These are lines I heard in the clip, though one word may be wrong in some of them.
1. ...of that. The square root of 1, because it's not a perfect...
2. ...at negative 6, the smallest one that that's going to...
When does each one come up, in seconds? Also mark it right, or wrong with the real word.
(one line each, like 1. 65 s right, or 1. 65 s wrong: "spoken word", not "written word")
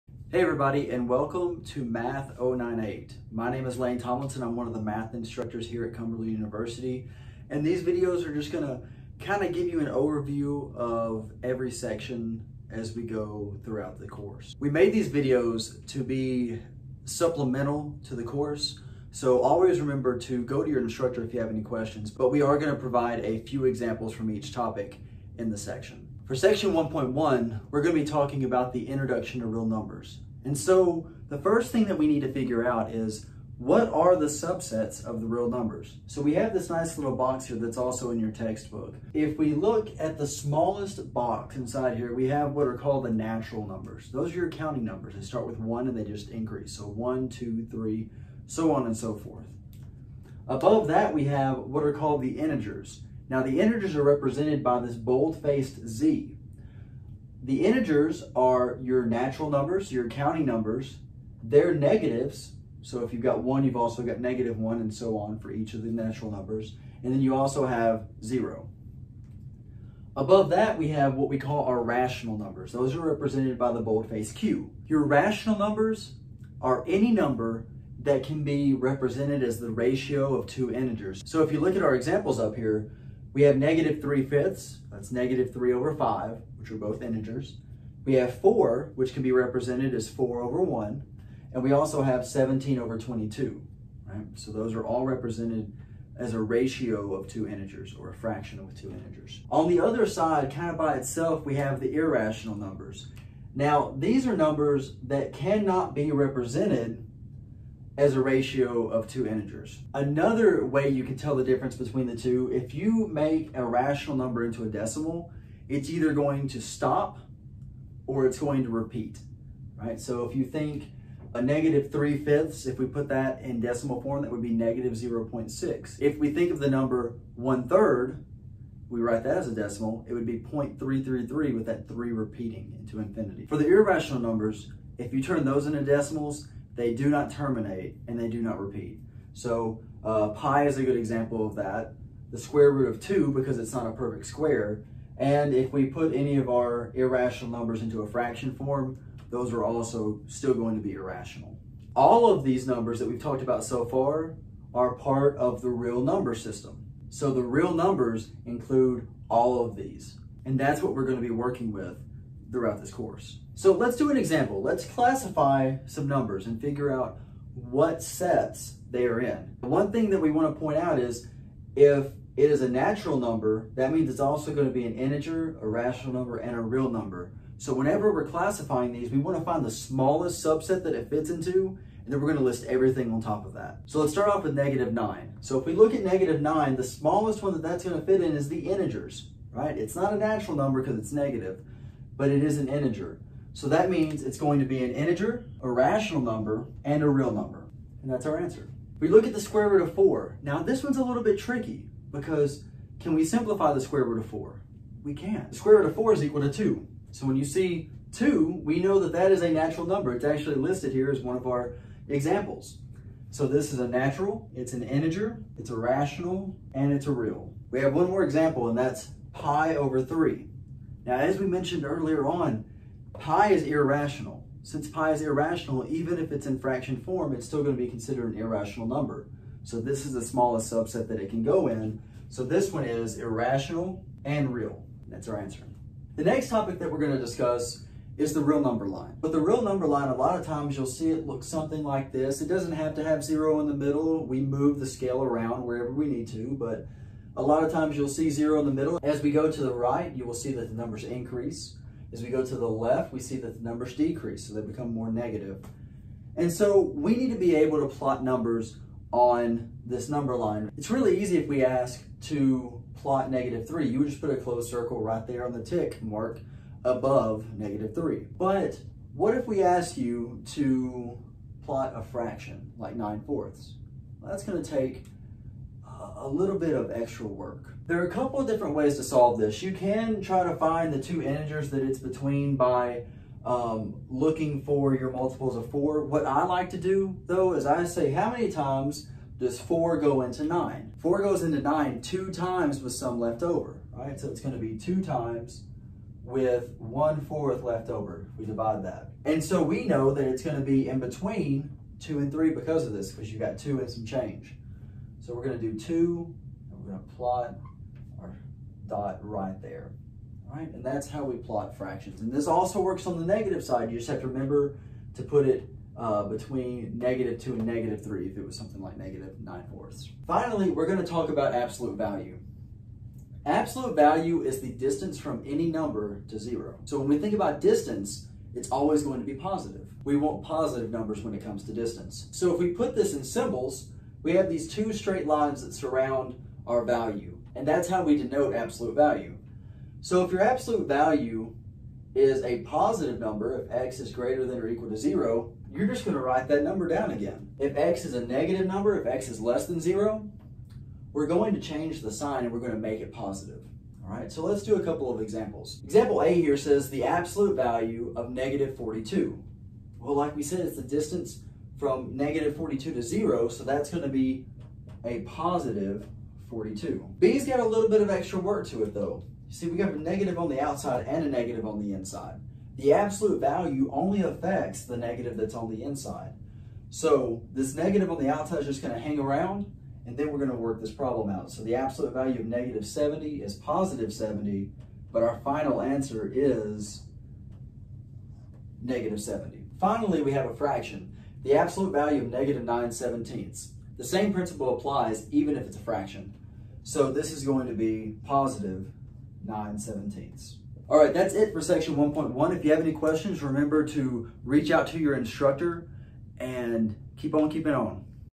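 1. 141 s wrong: "2", not "1"
2. 185 s wrong: "9", not "6".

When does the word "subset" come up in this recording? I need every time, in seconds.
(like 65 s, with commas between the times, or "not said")
34 s, 180 s, 230 s.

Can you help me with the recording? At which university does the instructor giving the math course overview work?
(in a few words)
Cumberland University.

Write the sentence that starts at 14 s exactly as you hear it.
We made these videos to be supplemental to the course.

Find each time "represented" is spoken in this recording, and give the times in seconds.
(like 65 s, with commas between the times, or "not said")
54 s, 72 s, 78 s, 89 s, 95 s, 106 s.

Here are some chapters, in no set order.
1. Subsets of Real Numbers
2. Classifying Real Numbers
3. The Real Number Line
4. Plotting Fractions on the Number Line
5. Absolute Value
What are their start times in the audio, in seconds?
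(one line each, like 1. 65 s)
1. 27 s
2. 163 s
3. 235 s
4. 269 s
5. 320 s.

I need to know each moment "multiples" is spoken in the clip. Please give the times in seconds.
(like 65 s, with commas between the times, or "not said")
285 s.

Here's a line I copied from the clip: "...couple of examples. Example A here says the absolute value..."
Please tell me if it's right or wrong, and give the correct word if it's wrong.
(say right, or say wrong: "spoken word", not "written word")
right.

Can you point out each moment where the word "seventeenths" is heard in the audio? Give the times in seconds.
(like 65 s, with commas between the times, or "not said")
392 s, 399 s.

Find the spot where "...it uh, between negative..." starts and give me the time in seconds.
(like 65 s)
315 s.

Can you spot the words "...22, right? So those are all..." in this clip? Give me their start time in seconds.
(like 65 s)
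92 s.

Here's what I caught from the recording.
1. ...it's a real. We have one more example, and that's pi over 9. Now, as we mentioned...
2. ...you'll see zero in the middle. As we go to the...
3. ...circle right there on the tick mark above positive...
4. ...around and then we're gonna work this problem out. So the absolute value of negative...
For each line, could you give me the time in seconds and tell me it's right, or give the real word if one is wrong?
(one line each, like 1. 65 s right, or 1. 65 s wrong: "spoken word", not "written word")
1. 216 s wrong: "3", not "9"
2. 247 s right
3. 264 s wrong: "negative", not "positive"
4. 379 s right.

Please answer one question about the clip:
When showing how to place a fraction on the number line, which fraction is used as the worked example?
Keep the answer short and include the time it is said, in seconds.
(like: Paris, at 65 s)
9/4, at 272 s.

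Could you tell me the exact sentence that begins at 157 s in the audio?
So the real numbers include all of these.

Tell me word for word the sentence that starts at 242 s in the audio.
It doesn't have to have zero in the middle.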